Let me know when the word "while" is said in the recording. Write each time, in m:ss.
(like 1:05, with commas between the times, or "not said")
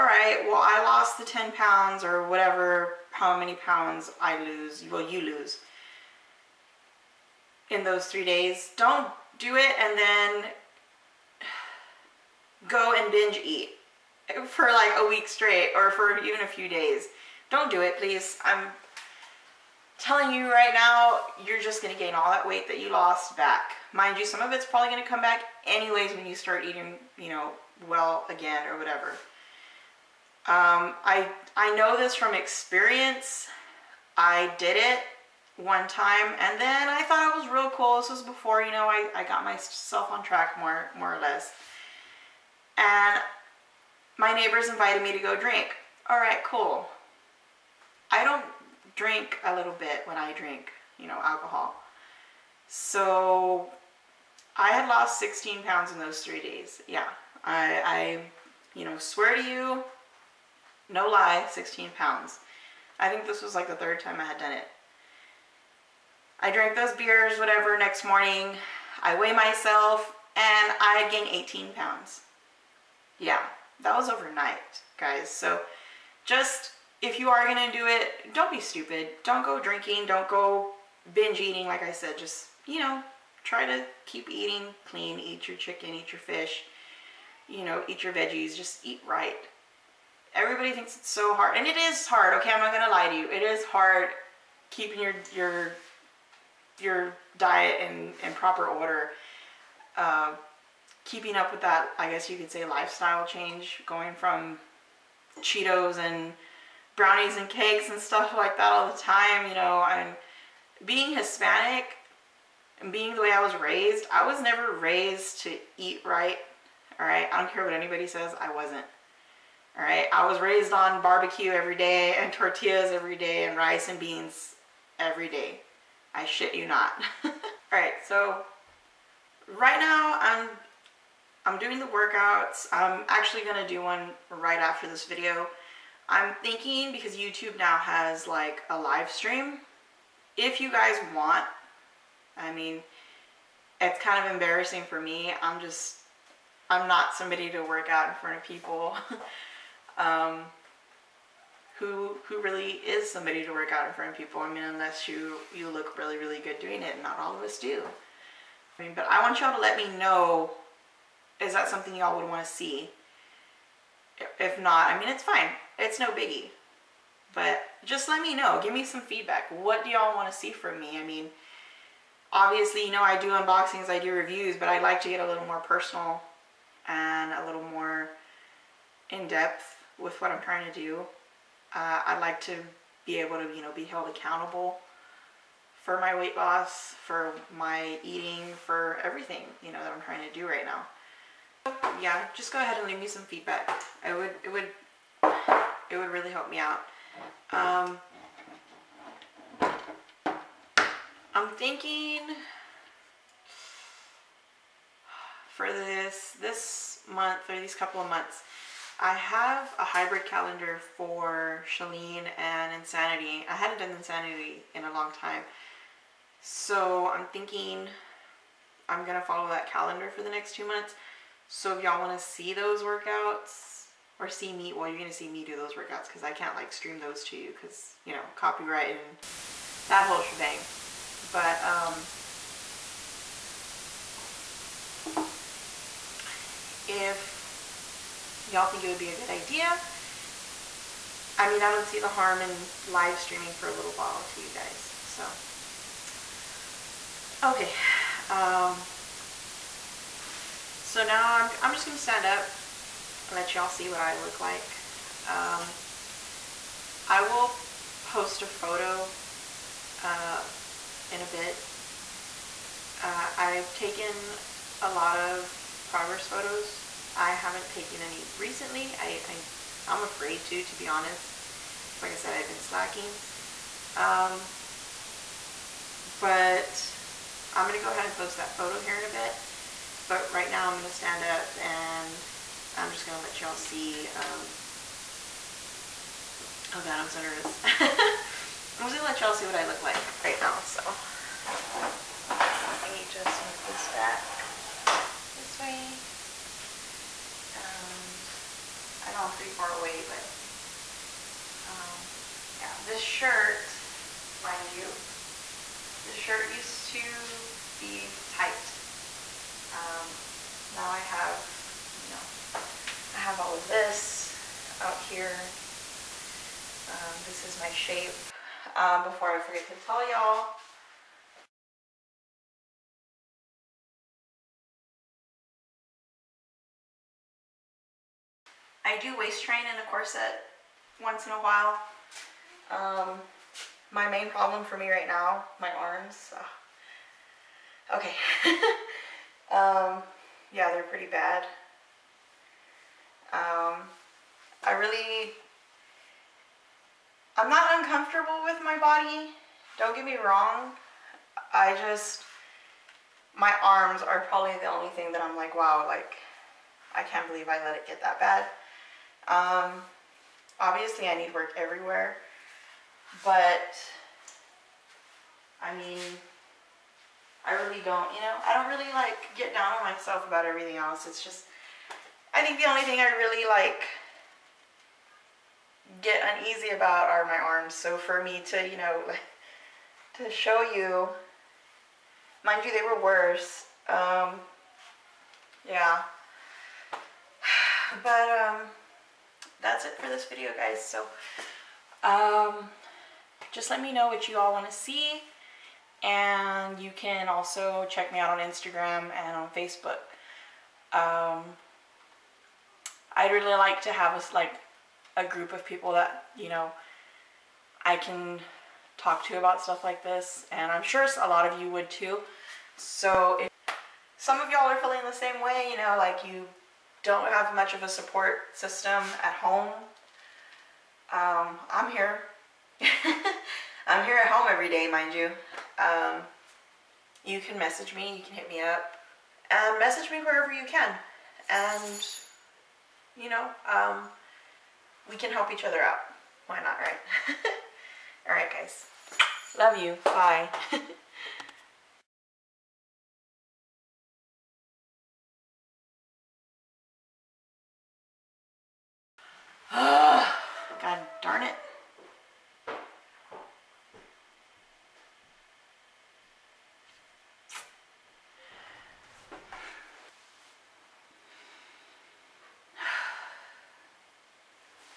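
4:03, 5:31.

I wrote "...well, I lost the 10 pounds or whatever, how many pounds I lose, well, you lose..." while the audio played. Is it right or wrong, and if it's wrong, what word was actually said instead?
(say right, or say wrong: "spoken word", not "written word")
right.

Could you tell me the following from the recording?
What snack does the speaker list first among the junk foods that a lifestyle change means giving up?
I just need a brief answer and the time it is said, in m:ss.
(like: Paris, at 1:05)
Cheetos, at 1:45.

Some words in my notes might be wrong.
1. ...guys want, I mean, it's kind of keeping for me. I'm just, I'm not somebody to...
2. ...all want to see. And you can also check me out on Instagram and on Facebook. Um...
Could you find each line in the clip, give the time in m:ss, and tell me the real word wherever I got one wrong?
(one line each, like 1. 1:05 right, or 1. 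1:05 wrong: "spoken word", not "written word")
1. 2:20 wrong: "embarrassing", not "keeping"
2. 6:34 right.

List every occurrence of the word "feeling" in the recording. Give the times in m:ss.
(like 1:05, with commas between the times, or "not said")
6:54.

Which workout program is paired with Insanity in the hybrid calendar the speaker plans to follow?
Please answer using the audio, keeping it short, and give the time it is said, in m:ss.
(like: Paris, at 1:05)
ChaLEAN, at 3:31.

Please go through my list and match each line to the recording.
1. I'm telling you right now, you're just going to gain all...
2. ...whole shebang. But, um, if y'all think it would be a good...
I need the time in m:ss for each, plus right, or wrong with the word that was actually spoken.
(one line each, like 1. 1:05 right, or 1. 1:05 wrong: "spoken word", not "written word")
1. 0:18 right
2. 3:50 right.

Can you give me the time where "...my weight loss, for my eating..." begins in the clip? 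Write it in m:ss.
3:05.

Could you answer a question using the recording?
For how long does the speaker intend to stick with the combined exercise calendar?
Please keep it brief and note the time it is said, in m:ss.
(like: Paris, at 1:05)
2 months, at 3:40.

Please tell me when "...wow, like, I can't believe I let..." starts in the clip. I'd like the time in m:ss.
5:55.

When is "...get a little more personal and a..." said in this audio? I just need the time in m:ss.
2:55.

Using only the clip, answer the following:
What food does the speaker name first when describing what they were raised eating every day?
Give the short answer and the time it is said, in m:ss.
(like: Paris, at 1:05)
barbecue, at 2:01.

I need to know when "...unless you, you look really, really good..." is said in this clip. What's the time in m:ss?
2:34.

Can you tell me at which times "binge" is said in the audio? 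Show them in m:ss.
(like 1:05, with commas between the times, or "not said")
0:13, 1:21.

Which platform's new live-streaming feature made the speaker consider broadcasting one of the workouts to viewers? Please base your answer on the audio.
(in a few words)
YouTube.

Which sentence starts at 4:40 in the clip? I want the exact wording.
But right now I'm going to stand up and I'm just going to let y'all see.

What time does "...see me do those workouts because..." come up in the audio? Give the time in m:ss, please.
3:45.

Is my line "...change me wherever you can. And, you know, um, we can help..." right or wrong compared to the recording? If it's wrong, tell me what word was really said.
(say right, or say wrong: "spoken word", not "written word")
wrong: "message", not "change".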